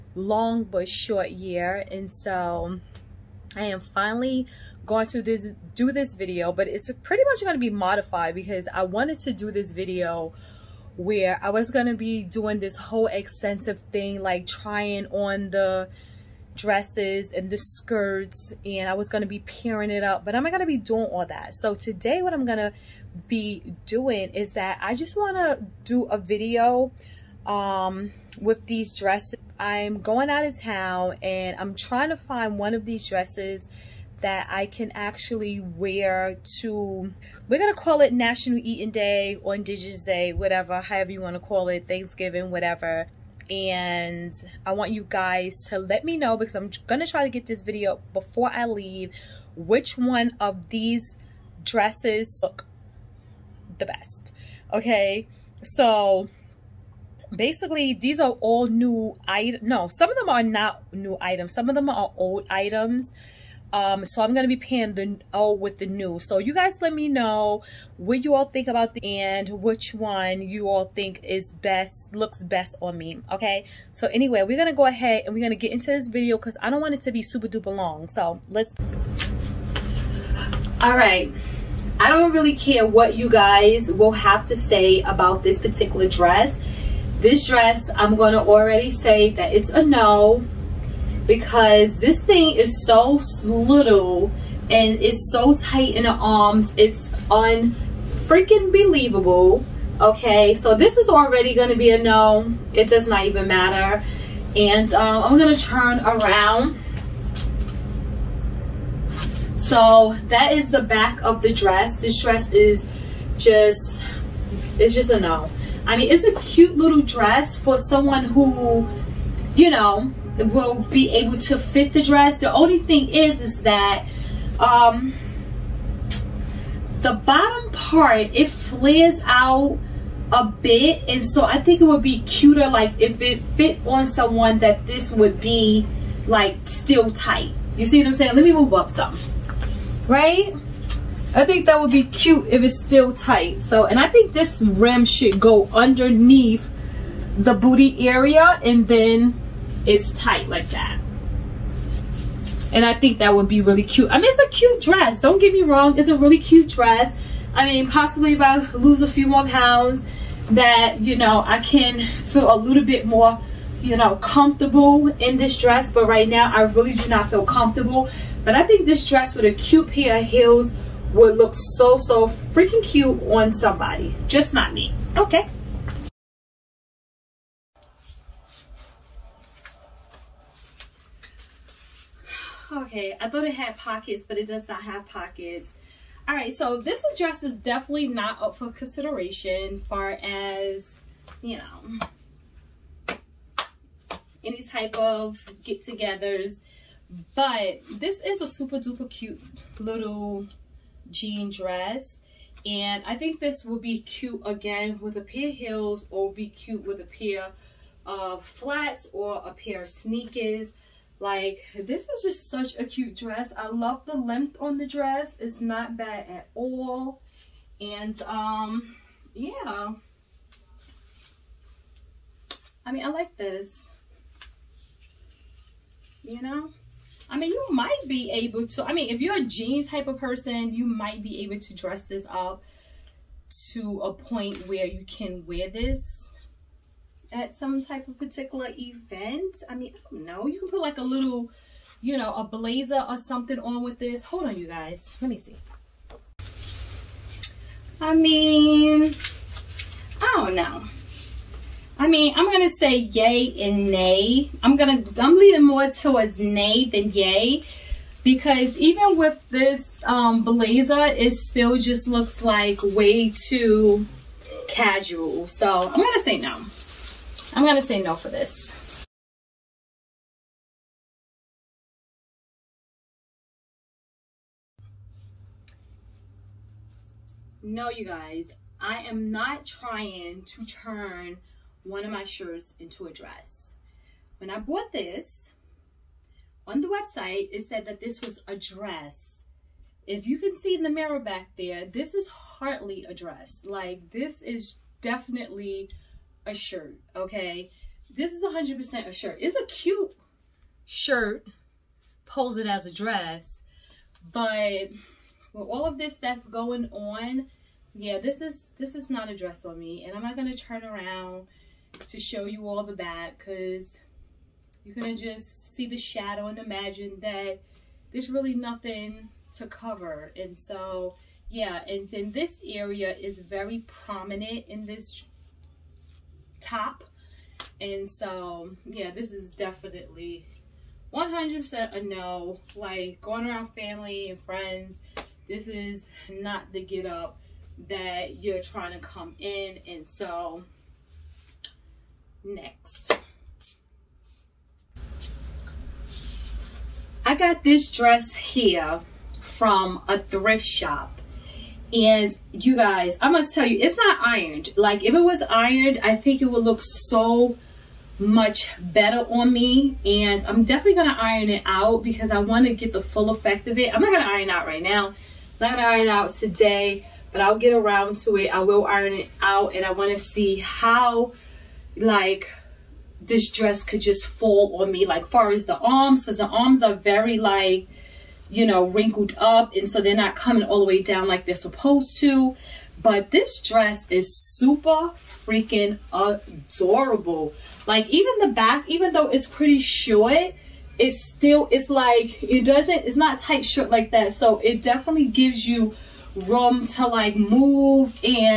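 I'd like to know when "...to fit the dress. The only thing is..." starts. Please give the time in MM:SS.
02:01.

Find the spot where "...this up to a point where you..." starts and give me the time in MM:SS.
03:52.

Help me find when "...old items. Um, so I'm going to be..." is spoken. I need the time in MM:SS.
01:02.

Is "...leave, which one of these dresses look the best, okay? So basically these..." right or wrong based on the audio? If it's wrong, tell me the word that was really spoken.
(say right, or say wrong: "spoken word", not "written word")
right.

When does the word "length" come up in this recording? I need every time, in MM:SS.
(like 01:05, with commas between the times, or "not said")
03:34.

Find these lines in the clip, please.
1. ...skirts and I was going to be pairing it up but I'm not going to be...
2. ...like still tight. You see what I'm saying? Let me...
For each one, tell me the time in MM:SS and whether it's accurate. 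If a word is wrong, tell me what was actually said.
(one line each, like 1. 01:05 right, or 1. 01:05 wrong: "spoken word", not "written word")
1. 00:17 right
2. 02:16 right.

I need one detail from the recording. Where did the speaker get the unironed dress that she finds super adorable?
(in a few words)
a thrift shop.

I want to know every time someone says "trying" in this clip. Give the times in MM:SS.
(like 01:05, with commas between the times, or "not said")
00:14, 00:31, 04:39, 05:38.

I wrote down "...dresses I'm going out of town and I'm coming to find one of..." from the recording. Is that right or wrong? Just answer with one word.
wrong.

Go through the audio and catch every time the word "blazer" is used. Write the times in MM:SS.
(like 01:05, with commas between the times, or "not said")
04:02, 04:20.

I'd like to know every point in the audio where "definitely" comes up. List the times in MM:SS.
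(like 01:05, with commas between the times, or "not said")
03:07, 04:55, 05:29, 06:00, 06:34.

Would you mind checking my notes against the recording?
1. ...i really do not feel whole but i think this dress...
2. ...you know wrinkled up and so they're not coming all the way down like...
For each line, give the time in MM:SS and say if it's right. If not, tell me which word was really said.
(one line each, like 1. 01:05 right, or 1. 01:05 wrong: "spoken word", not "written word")
1. 02:46 wrong: "comfortable", not "whole"
2. 06:18 right.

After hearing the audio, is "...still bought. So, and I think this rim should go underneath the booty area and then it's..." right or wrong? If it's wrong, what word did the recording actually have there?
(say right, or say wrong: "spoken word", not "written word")
wrong: "tight", not "bought".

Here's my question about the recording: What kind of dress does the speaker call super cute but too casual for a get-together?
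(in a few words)
jean dress.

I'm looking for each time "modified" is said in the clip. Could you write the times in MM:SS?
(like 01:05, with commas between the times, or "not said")
00:07.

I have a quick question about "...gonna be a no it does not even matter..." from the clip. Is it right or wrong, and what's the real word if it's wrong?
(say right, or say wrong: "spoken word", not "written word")
right.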